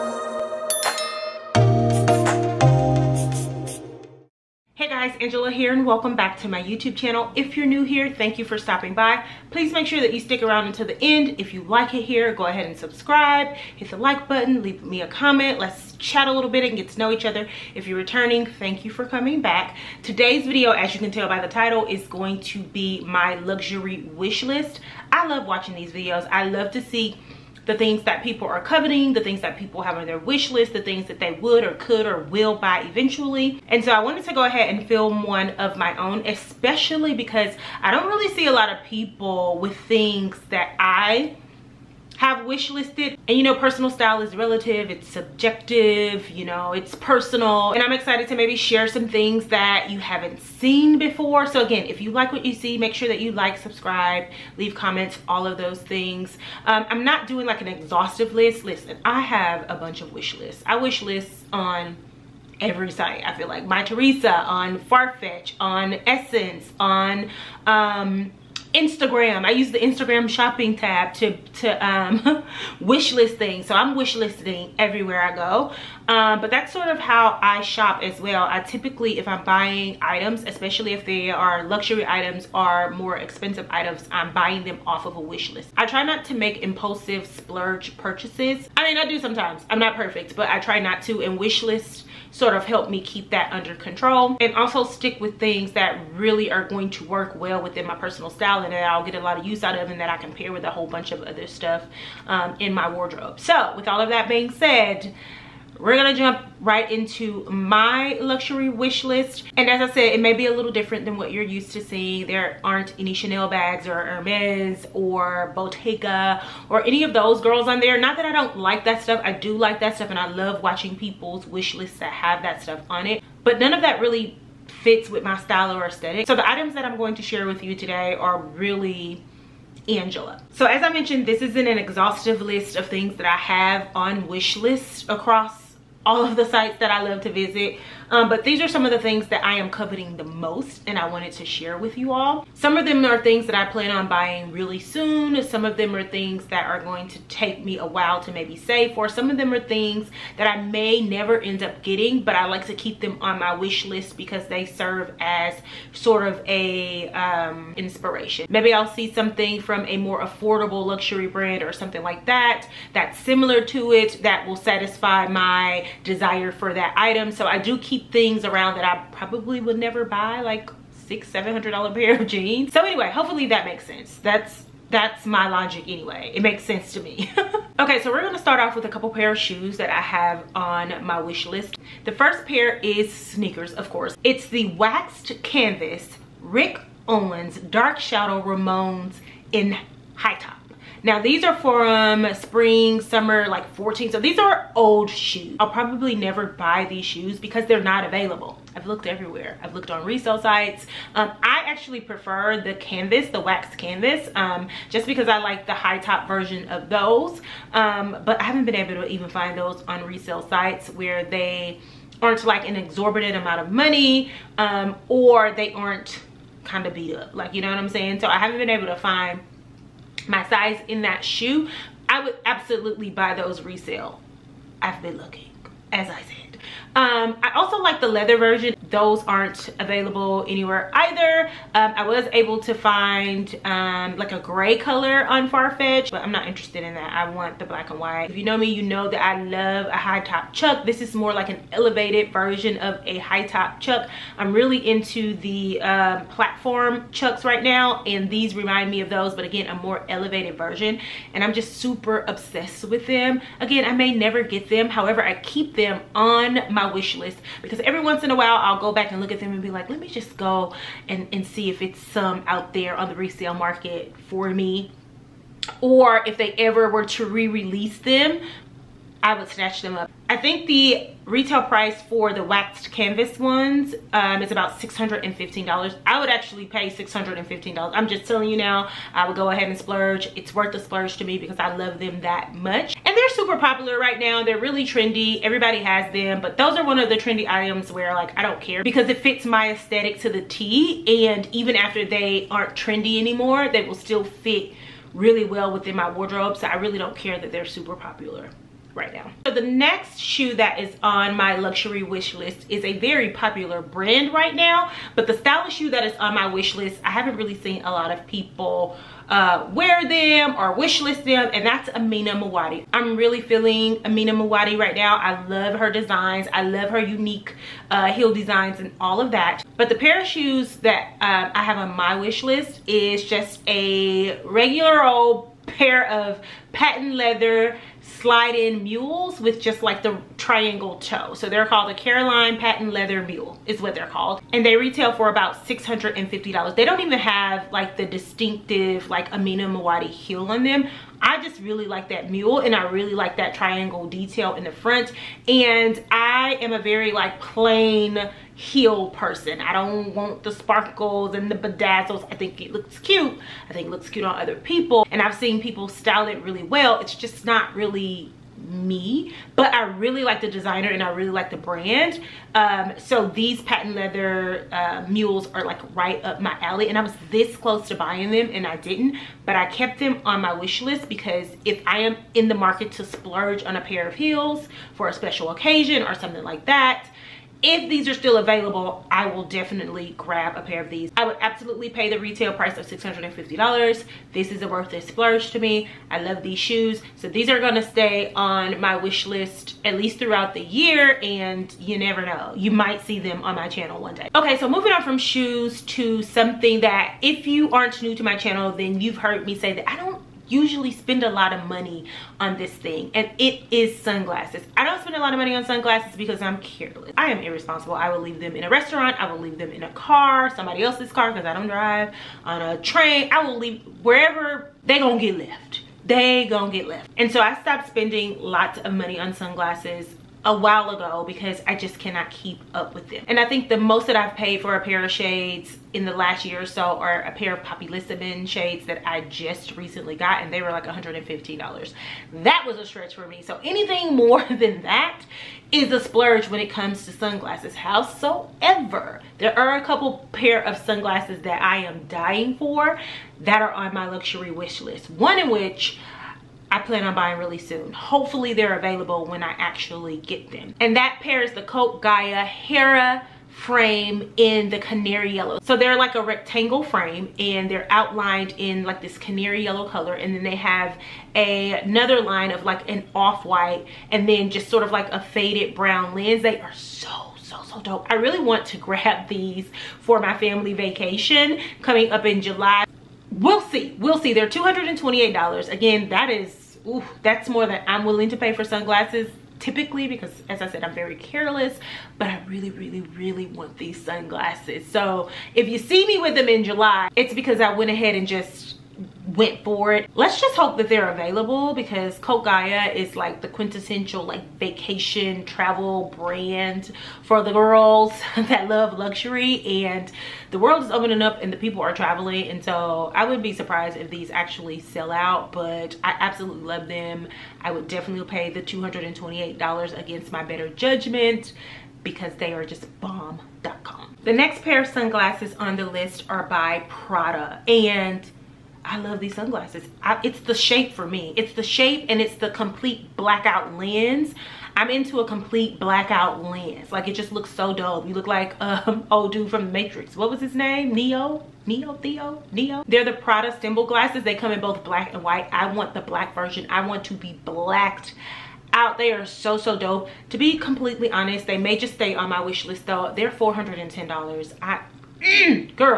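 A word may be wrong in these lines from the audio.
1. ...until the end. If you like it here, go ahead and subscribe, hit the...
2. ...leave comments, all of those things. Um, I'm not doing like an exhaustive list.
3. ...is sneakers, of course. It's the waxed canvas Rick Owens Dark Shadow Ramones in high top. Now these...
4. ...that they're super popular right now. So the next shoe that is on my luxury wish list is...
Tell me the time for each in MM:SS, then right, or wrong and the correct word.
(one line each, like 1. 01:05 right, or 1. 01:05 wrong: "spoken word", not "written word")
1. 00:10 right
2. 00:54 right
3. 03:02 right
4. 04:57 right.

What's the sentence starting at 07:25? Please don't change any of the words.
One in which I plan on buying really soon.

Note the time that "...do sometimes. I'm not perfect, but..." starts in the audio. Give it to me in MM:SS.
01:29.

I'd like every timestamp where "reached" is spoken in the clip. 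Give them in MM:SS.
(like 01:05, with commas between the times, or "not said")
not said.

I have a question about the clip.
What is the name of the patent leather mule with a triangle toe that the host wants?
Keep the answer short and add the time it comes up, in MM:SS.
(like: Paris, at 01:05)
Caroline, at 05:31.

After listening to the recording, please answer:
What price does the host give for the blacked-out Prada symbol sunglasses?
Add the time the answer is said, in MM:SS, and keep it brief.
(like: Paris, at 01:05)
$410, at 09:03.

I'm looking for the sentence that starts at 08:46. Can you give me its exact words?
Like it just looks so dope.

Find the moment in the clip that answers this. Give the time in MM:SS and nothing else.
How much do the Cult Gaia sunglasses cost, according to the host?
07:54.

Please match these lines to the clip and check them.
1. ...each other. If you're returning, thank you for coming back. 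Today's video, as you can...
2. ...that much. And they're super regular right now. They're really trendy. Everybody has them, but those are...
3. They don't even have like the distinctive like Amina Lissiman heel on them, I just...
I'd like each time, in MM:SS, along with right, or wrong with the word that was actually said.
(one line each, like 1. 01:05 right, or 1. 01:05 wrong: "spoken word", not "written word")
1. 00:17 right
2. 04:42 wrong: "popular", not "regular"
3. 05:36 wrong: "Muaddi", not "Lissiman".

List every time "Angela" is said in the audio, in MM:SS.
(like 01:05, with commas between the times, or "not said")
00:05, 02:09.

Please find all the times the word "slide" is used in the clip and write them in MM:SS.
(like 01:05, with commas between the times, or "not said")
05:28.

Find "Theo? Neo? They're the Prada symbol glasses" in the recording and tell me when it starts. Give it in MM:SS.
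08:51.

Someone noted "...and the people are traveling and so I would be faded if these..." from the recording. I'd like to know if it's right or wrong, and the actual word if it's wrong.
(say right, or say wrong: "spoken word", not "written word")
wrong: "surprised", not "faded".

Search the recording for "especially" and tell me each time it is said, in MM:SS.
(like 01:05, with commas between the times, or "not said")
00:36, 01:20.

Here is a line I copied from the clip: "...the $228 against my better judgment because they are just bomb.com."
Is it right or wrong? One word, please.
right.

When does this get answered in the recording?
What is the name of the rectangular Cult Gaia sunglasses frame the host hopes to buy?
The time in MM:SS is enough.
07:32.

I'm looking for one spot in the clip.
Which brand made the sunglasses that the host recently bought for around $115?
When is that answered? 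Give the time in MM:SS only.
07:07.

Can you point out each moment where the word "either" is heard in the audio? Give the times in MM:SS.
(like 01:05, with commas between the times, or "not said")
03:50.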